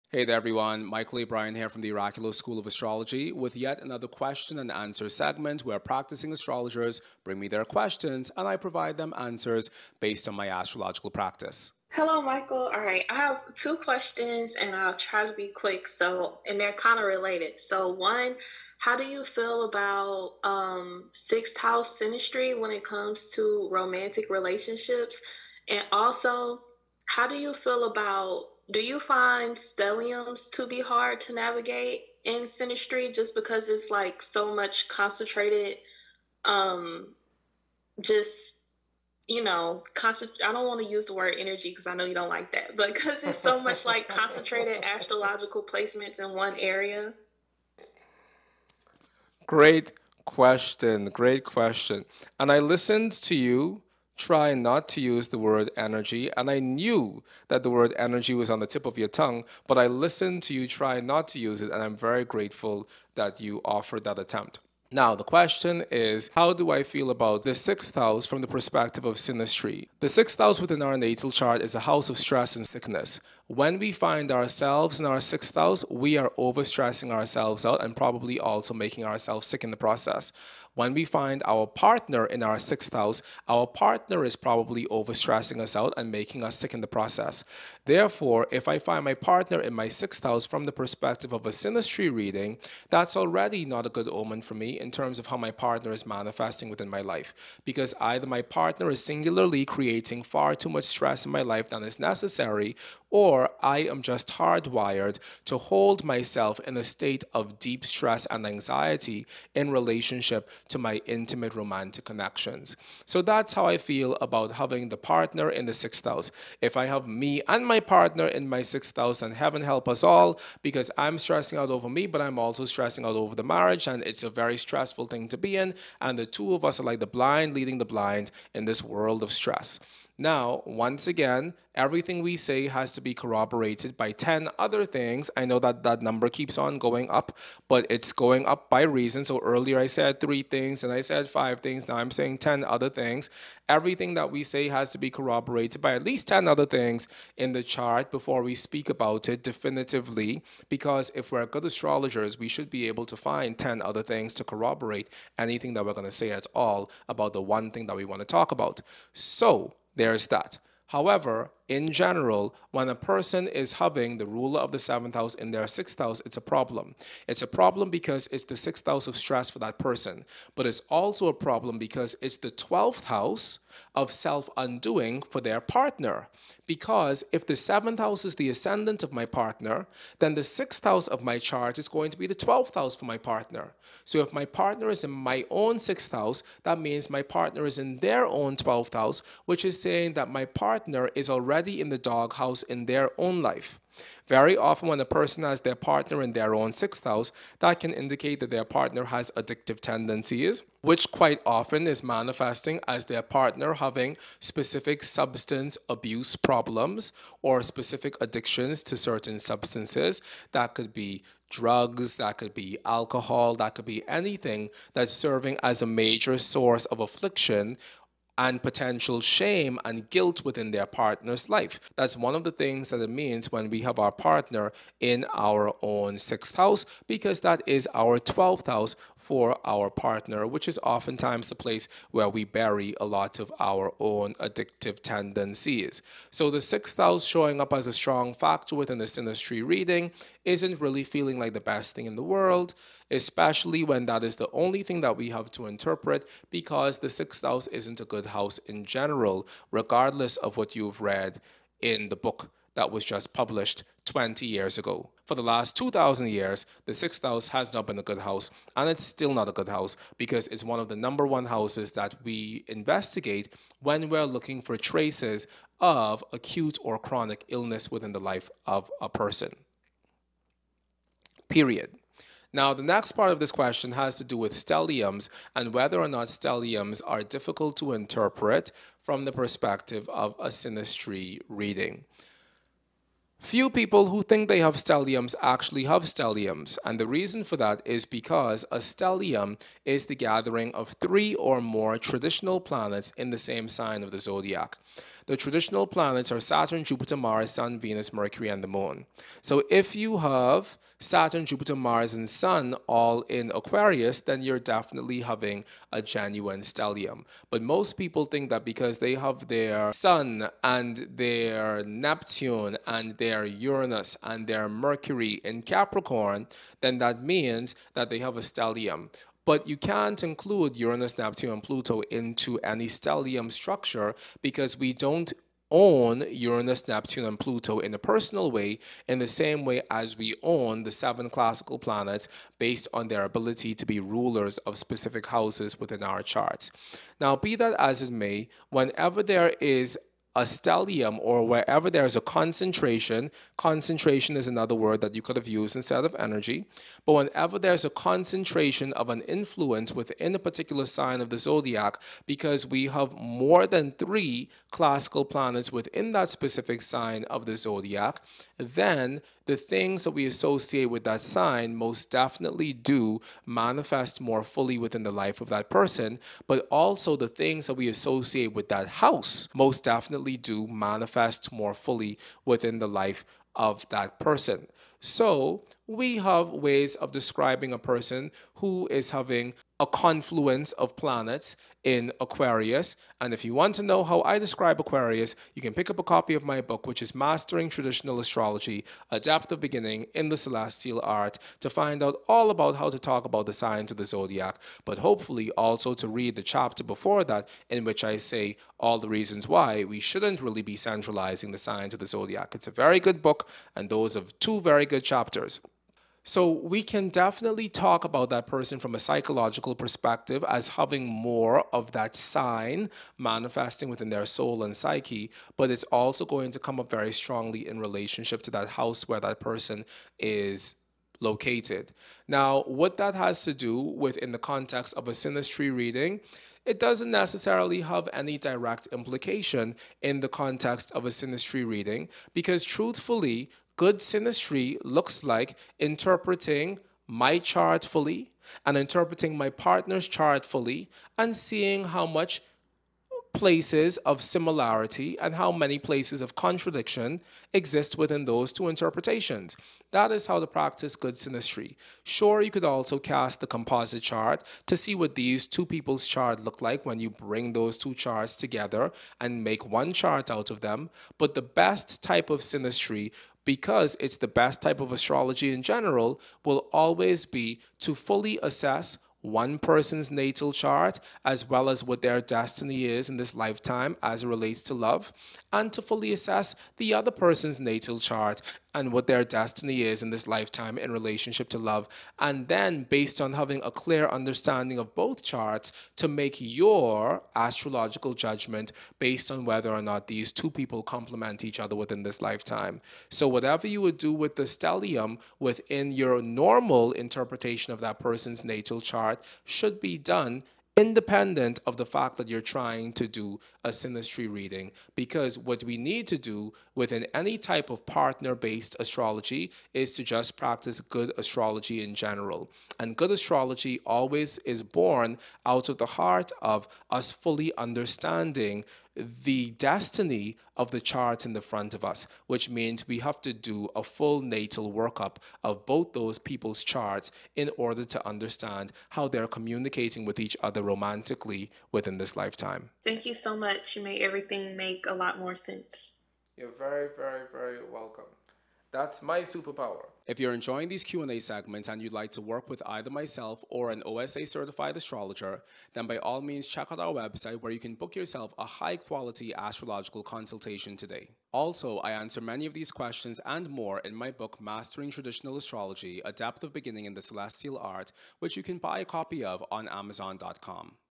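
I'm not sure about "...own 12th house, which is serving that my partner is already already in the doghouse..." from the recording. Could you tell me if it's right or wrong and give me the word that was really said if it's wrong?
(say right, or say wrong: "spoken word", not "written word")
wrong: "saying", not "serving".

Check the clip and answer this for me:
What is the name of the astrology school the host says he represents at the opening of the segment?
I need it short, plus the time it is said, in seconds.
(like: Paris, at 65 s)
Oraculos School of Astrology, at 1 s.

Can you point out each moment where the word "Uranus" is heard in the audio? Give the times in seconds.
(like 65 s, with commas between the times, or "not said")
313 s, 320 s, 326 s.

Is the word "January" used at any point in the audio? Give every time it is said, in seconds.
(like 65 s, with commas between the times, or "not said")
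not said.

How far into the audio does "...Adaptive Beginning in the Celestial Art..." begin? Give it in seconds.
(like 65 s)
389 s.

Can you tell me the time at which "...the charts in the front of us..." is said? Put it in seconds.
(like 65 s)
520 s.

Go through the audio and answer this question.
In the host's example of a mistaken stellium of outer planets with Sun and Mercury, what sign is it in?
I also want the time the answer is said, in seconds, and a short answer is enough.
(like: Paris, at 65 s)
Capricorn, at 315 s.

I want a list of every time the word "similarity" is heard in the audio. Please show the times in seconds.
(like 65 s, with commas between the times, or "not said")
444 s.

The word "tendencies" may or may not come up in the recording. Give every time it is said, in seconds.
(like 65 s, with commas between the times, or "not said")
199 s, 235 s.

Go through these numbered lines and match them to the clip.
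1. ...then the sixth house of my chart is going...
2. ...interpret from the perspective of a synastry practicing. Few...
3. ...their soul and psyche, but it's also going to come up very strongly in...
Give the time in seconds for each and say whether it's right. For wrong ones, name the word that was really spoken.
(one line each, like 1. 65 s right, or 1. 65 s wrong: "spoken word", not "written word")
1. 180 s right
2. 277 s wrong: "reading", not "practicing"
3. 414 s right.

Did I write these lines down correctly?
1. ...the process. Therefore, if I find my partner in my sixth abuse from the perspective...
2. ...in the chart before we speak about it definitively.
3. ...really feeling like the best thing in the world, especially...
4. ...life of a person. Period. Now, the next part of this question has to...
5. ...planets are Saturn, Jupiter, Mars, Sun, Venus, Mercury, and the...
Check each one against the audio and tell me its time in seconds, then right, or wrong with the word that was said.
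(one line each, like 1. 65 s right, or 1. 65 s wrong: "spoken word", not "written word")
1. 86 s wrong: "house", not "abuse"
2. 147 s right
3. 240 s right
4. 268 s right
5. 295 s right.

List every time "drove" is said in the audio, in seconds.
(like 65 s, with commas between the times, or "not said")
not said.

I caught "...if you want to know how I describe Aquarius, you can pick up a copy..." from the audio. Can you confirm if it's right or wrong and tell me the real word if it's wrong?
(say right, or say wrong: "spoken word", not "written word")
right.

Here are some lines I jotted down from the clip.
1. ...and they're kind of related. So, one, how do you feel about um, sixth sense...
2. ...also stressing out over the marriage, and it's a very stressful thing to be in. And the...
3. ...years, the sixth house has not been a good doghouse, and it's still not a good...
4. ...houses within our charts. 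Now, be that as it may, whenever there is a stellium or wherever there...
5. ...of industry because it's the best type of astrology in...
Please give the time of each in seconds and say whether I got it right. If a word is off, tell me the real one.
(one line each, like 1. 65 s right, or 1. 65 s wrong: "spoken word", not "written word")
1. 16 s wrong: "house", not "sense"
2. 122 s right
3. 256 s wrong: "house", not "doghouse"
4. 335 s right
5. 462 s wrong: "synastry", not "industry".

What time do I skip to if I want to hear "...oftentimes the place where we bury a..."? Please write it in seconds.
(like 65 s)
230 s.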